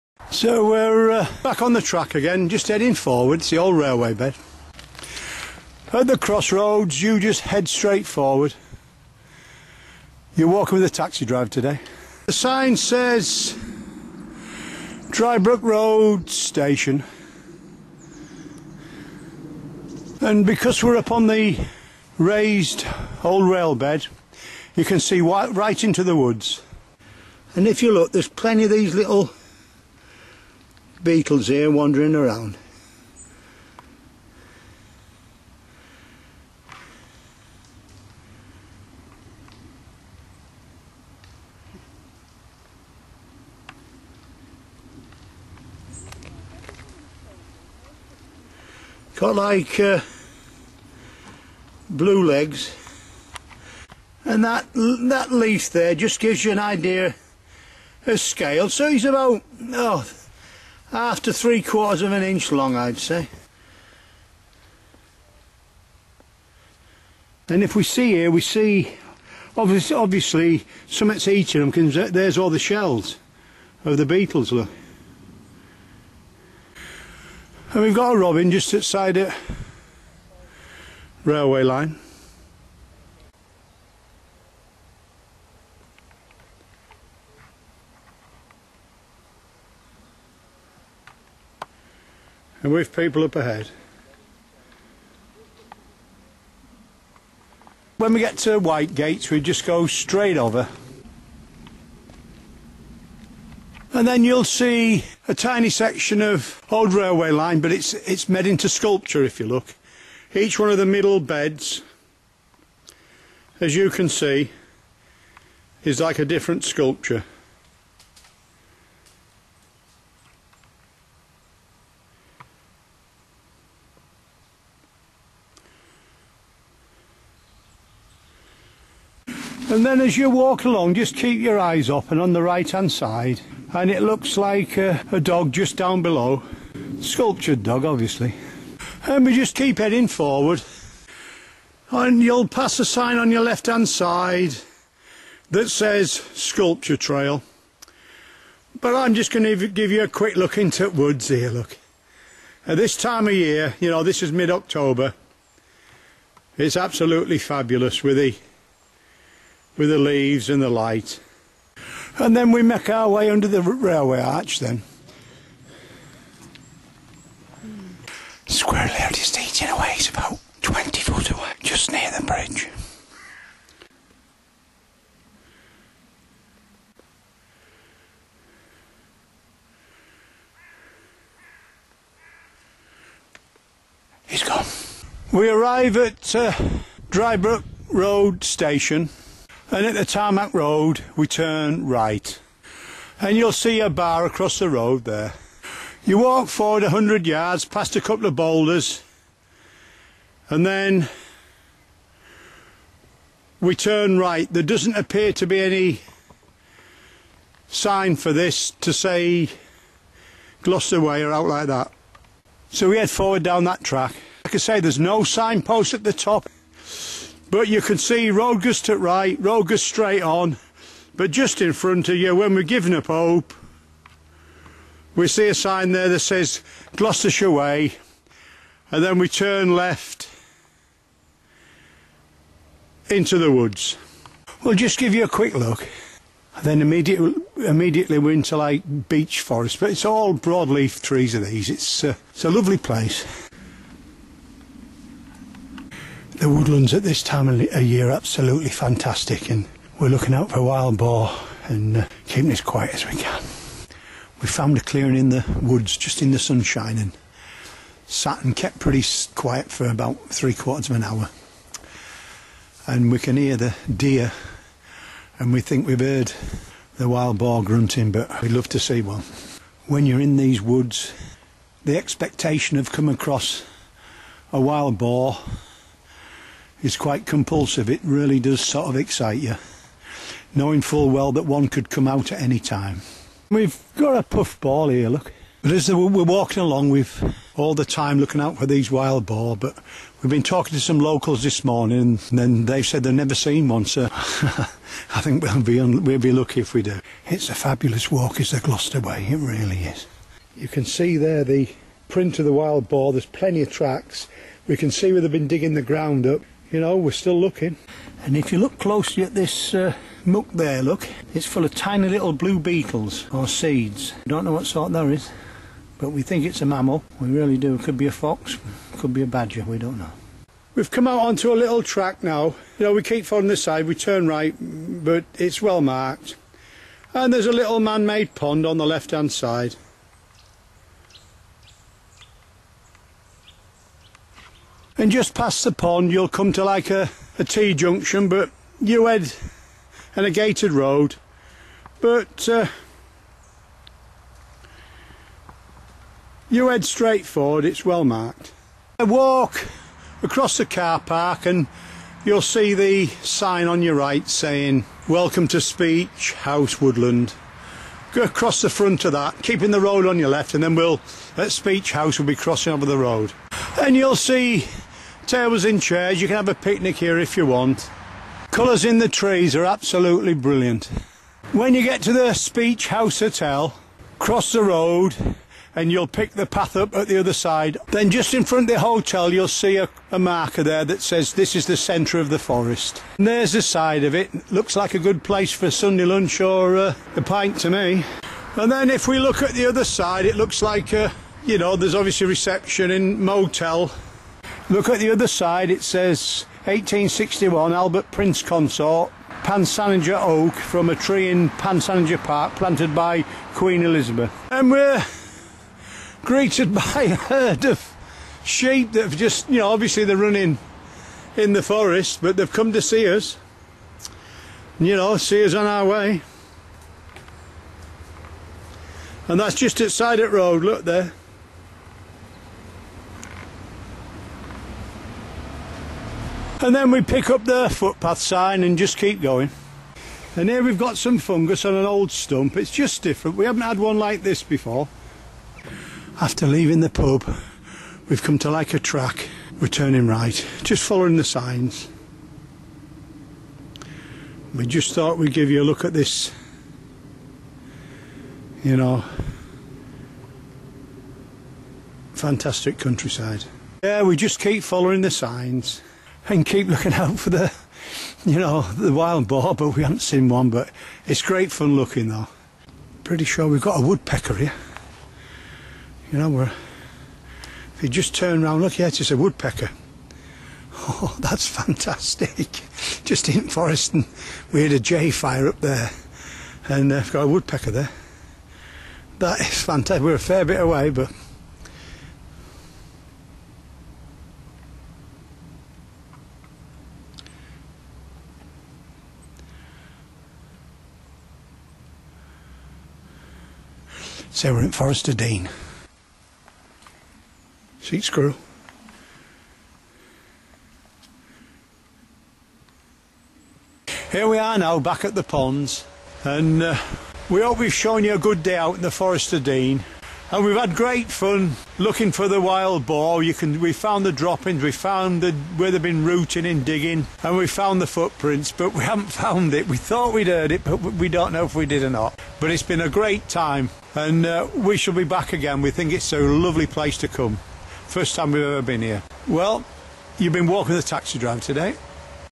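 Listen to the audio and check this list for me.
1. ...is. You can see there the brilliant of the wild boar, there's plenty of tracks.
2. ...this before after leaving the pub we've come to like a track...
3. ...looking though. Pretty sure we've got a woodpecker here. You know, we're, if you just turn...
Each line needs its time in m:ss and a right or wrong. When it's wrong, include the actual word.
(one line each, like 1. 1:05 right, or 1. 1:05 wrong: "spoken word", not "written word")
1. 4:59 wrong: "print", not "brilliant"
2. 7:14 right
3. 7:41 right.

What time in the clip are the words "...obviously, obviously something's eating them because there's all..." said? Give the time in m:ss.
1:09.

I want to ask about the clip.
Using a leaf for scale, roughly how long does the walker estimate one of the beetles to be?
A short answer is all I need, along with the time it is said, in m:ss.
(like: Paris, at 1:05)
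3/4 of an inch, at 1:01.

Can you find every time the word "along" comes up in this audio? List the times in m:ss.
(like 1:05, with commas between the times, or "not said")
2:10, 4:46.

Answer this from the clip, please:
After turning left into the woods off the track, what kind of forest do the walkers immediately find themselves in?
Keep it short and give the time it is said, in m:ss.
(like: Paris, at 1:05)
Beech forest, at 3:59.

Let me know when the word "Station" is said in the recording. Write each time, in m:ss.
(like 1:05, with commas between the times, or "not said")
0:16, 3:08.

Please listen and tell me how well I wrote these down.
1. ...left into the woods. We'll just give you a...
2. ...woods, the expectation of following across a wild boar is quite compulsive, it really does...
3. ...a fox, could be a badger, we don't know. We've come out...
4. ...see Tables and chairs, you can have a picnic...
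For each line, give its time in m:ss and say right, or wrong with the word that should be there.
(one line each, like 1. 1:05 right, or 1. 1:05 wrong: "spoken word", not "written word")
1. 3:49 right
2. 4:30 wrong: "coming", not "following"
3. 5:18 right
4. 6:04 right.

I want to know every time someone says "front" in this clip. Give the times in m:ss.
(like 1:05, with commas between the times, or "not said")
3:41, 5:58, 6:18.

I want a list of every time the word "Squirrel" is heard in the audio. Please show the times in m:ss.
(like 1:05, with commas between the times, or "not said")
2:48.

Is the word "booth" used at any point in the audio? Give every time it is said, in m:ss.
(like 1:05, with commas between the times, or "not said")
not said.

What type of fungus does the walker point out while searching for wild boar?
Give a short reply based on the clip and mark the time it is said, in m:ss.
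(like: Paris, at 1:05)
Puff ball, at 4:44.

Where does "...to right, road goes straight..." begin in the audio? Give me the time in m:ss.
3:38.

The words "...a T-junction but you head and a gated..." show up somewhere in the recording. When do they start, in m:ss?
5:37.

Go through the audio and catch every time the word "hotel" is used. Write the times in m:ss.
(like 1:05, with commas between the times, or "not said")
6:13, 6:18.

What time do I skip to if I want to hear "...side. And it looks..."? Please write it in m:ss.
2:12.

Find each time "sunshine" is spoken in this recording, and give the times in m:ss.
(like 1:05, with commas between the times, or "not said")
4:16.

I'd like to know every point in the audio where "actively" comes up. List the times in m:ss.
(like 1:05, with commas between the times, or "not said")
not said.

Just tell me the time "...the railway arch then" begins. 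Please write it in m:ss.
2:43.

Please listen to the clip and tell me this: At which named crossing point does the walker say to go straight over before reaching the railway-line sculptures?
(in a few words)
White Gates.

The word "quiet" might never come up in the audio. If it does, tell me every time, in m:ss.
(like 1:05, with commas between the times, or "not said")
4:12, 4:19.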